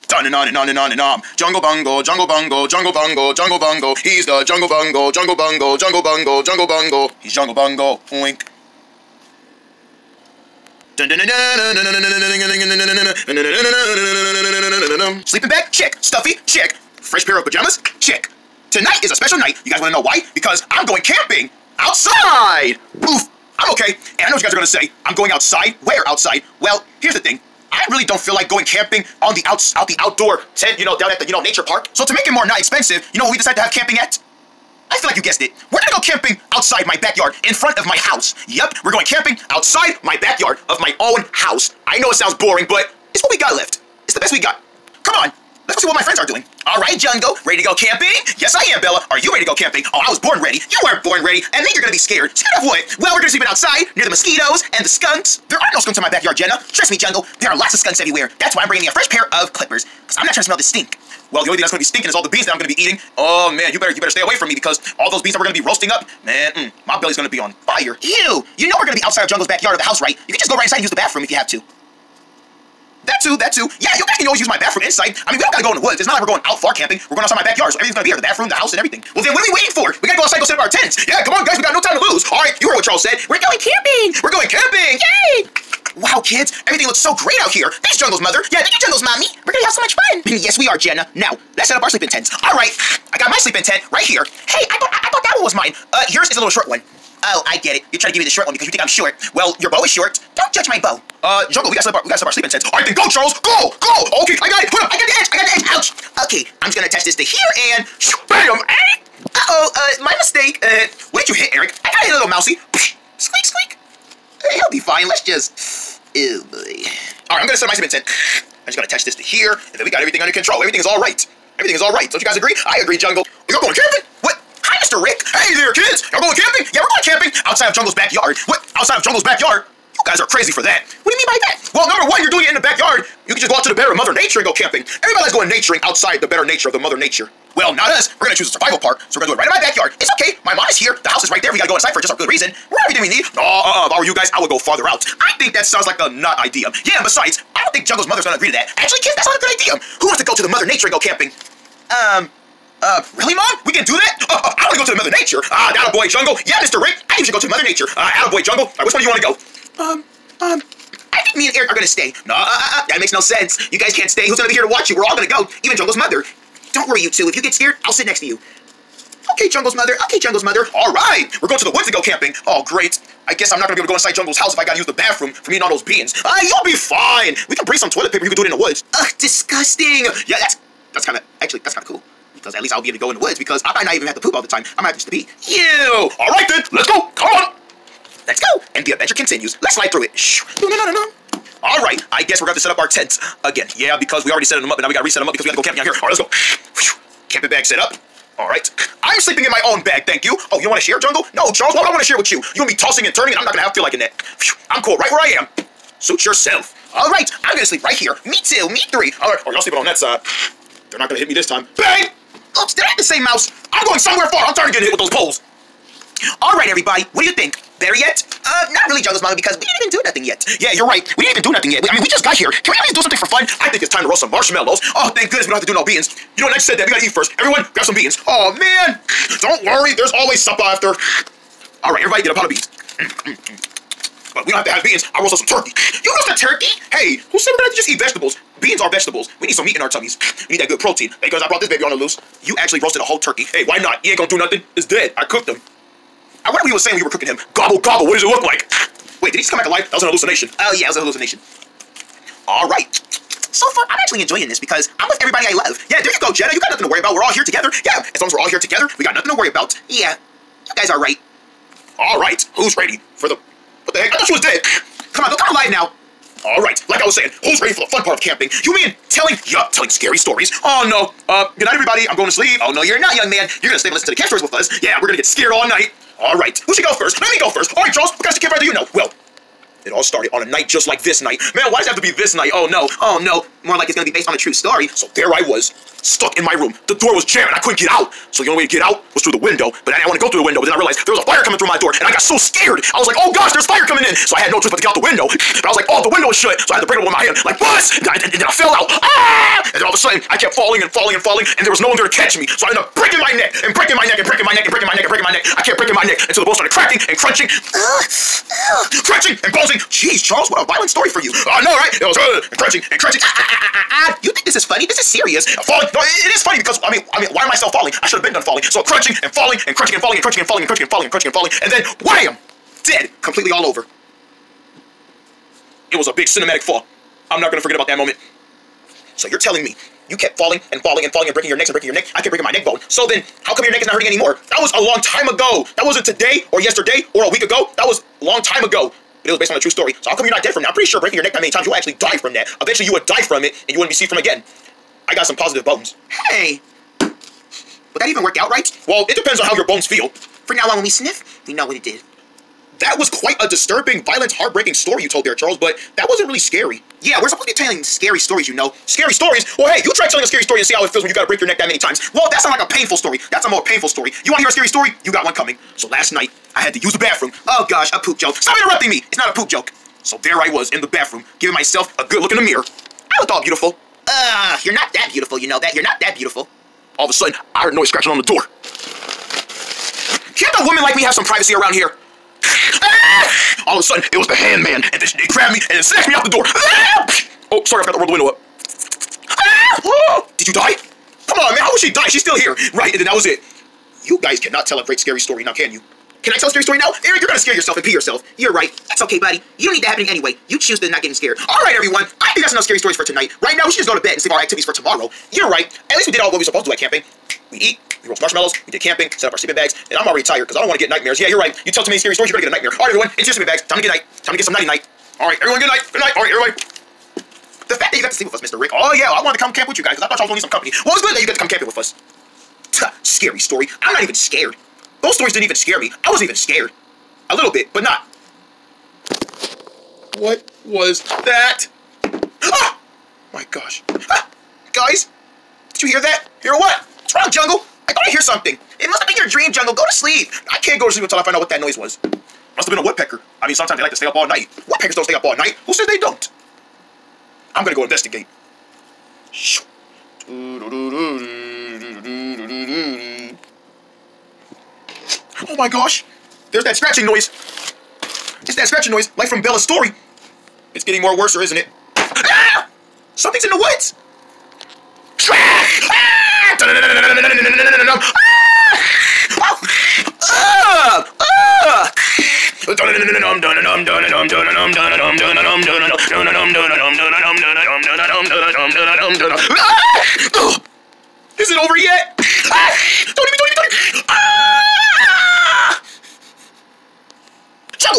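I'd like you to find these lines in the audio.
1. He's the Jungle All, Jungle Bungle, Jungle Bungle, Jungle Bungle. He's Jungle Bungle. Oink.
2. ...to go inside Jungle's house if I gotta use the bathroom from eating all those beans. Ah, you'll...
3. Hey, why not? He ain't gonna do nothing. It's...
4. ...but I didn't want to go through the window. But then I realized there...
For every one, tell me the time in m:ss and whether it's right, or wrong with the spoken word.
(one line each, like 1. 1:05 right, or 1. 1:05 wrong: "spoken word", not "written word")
1. 0:04 wrong: "Bungle", not "All"
2. 2:53 right
3. 4:03 right
4. 4:49 right.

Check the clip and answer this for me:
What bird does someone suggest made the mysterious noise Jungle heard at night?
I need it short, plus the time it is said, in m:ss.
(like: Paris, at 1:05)
A woodpecker, at 7:22.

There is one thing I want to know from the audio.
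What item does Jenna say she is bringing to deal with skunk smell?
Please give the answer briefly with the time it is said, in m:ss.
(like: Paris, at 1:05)
Clippers, at 0:58.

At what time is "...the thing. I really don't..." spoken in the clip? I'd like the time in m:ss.
0:27.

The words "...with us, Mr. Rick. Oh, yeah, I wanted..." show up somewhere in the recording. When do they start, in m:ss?
6:58.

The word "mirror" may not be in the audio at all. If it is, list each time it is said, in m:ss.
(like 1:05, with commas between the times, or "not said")
6:12.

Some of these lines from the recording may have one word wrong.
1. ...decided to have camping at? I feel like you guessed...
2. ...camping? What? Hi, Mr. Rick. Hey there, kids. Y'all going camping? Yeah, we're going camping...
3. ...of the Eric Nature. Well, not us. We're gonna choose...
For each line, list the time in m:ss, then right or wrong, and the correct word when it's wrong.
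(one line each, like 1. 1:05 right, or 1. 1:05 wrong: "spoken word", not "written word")
1. 0:33 right
2. 2:03 right
3. 2:16 wrong: "Mother", not "Eric".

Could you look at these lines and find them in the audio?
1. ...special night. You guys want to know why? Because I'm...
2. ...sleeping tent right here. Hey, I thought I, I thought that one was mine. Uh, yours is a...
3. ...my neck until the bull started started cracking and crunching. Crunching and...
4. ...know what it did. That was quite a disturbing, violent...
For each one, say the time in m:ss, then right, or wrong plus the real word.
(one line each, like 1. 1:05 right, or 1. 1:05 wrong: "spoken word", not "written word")
1. 0:19 right
2. 1:33 right
3. 5:05 right
4. 5:51 right.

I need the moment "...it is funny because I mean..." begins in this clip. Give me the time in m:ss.
5:16.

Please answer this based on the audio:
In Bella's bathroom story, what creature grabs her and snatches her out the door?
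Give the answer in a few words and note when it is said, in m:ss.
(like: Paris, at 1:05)
The hand man, at 6:24.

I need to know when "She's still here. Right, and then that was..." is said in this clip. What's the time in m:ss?
6:32.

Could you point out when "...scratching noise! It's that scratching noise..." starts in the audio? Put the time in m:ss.
7:36.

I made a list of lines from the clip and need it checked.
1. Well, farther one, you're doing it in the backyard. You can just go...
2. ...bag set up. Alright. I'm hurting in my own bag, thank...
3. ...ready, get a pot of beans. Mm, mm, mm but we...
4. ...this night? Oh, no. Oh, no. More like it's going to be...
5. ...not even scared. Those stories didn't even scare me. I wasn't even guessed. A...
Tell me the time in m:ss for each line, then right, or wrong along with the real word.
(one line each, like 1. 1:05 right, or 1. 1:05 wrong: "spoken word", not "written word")
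1. 2:11 wrong: "number", not "farther"
2. 3:17 wrong: "sleeping", not "hurting"
3. 3:52 wrong: "everybody", not "ready"
4. 4:42 right
5. 7:03 wrong: "scared", not "guessed".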